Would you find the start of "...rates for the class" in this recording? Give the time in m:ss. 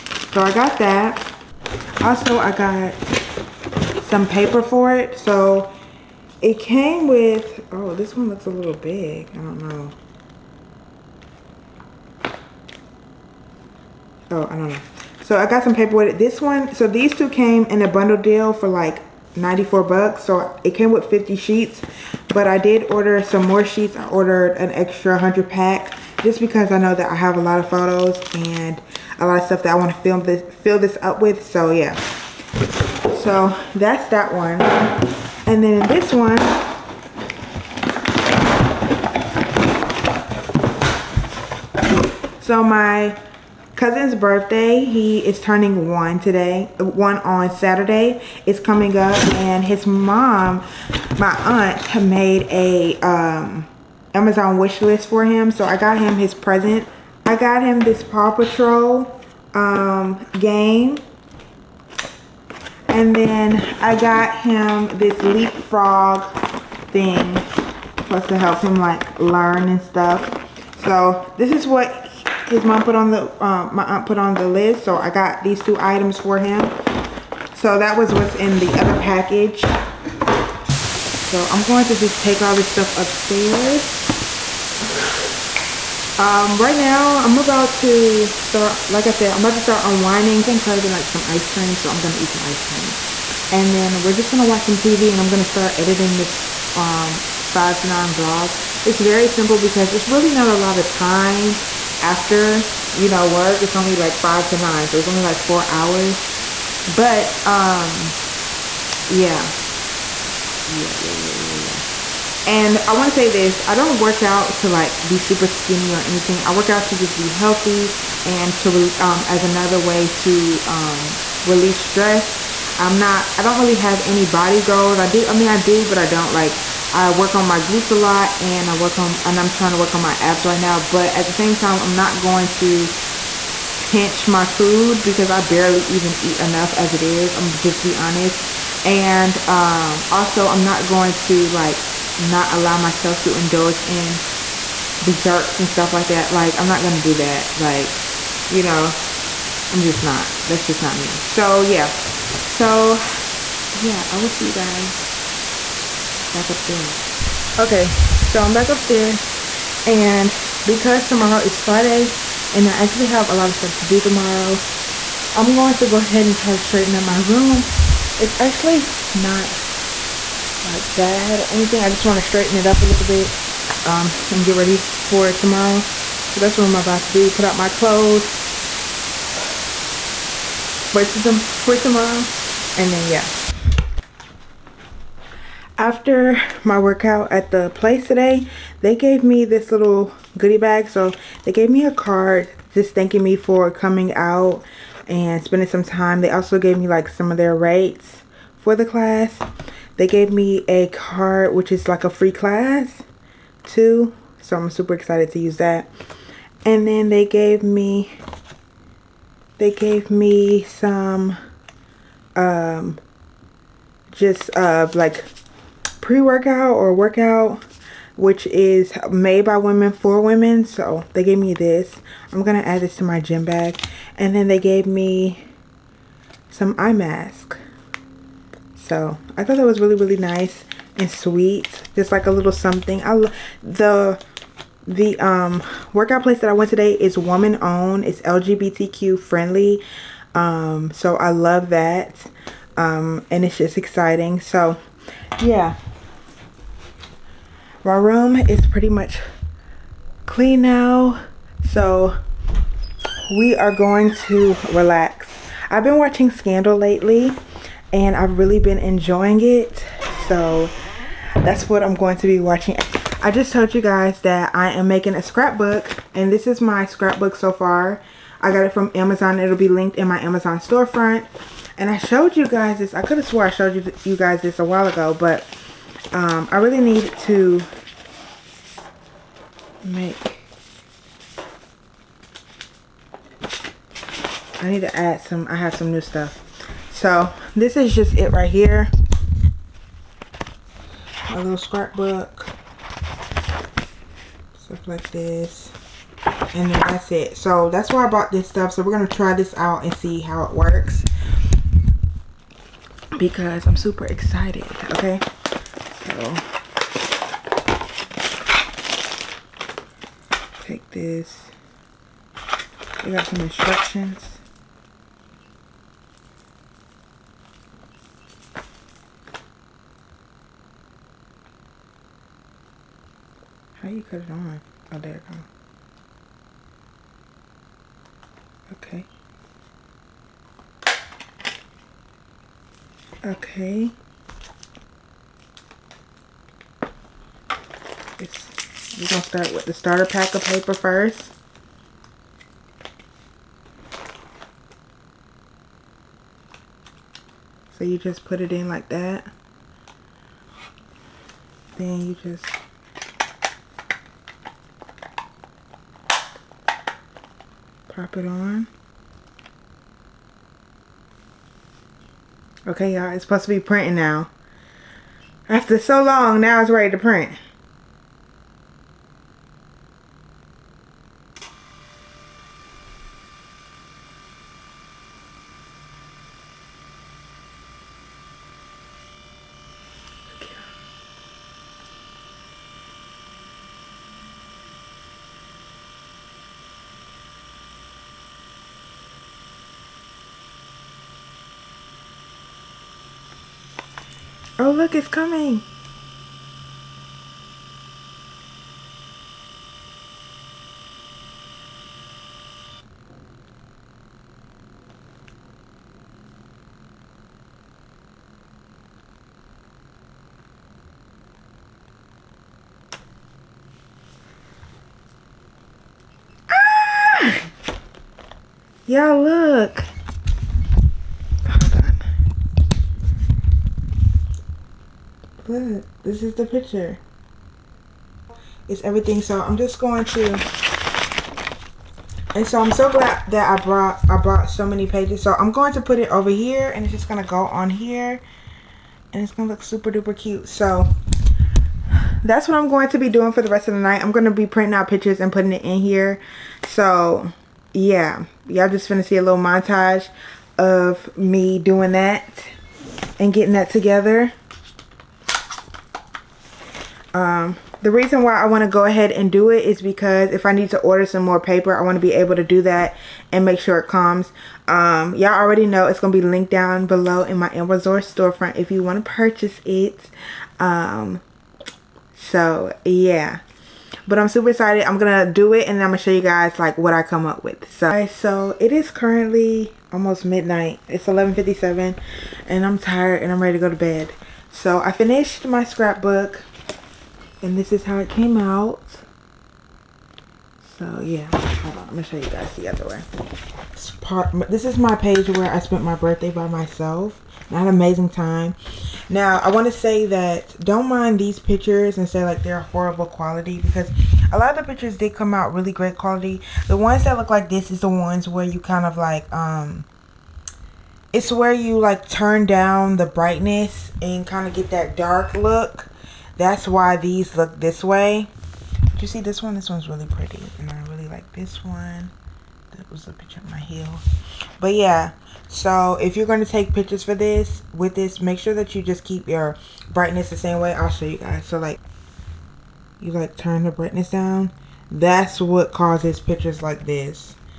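3:17.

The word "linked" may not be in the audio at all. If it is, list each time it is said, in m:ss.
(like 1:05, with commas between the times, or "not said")
4:29, 7:46.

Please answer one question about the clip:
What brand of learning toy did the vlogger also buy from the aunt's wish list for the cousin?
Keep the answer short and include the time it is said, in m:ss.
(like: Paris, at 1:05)
LeapFrog, at 1:05.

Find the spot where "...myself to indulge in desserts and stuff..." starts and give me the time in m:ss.
2:22.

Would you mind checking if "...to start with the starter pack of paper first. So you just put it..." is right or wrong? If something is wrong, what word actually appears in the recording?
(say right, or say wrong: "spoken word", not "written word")
right.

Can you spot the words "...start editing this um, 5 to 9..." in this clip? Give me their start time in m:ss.
1:35.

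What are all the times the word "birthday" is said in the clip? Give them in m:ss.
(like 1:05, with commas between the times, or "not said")
0:44, 8:15.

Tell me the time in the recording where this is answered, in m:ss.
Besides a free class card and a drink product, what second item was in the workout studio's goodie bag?
3:46.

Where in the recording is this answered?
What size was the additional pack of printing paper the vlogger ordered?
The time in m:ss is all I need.
0:25.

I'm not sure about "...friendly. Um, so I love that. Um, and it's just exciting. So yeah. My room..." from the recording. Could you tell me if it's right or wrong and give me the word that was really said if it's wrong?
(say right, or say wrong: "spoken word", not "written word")
right.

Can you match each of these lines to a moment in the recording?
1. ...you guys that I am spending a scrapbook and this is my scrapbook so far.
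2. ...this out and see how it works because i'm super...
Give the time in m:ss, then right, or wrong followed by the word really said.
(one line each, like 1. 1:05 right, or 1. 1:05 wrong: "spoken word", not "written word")
1. 4:23 wrong: "making", not "spending"
2. 4:59 right.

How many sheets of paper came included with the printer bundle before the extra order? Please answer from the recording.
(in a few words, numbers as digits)
50.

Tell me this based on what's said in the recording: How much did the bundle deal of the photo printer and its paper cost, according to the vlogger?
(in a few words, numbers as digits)
$94.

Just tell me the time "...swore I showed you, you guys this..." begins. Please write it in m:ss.
4:33.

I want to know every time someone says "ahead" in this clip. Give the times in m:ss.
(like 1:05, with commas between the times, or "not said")
2:45, 7:38.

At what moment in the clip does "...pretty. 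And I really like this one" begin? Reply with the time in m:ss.
8:40.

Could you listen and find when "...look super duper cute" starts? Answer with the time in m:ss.
7:19.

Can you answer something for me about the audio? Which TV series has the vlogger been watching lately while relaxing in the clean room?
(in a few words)
Scandal.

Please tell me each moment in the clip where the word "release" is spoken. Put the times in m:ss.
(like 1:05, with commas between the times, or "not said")
2:01.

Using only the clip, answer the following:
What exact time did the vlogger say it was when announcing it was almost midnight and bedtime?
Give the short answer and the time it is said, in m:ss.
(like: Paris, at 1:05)
11:57, at 8:01.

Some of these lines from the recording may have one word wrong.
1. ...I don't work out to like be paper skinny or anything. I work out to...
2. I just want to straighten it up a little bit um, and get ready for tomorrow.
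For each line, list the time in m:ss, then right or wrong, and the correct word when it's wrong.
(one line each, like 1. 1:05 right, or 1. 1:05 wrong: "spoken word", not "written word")
1. 1:53 wrong: "super", not "paper"
2. 2:51 right.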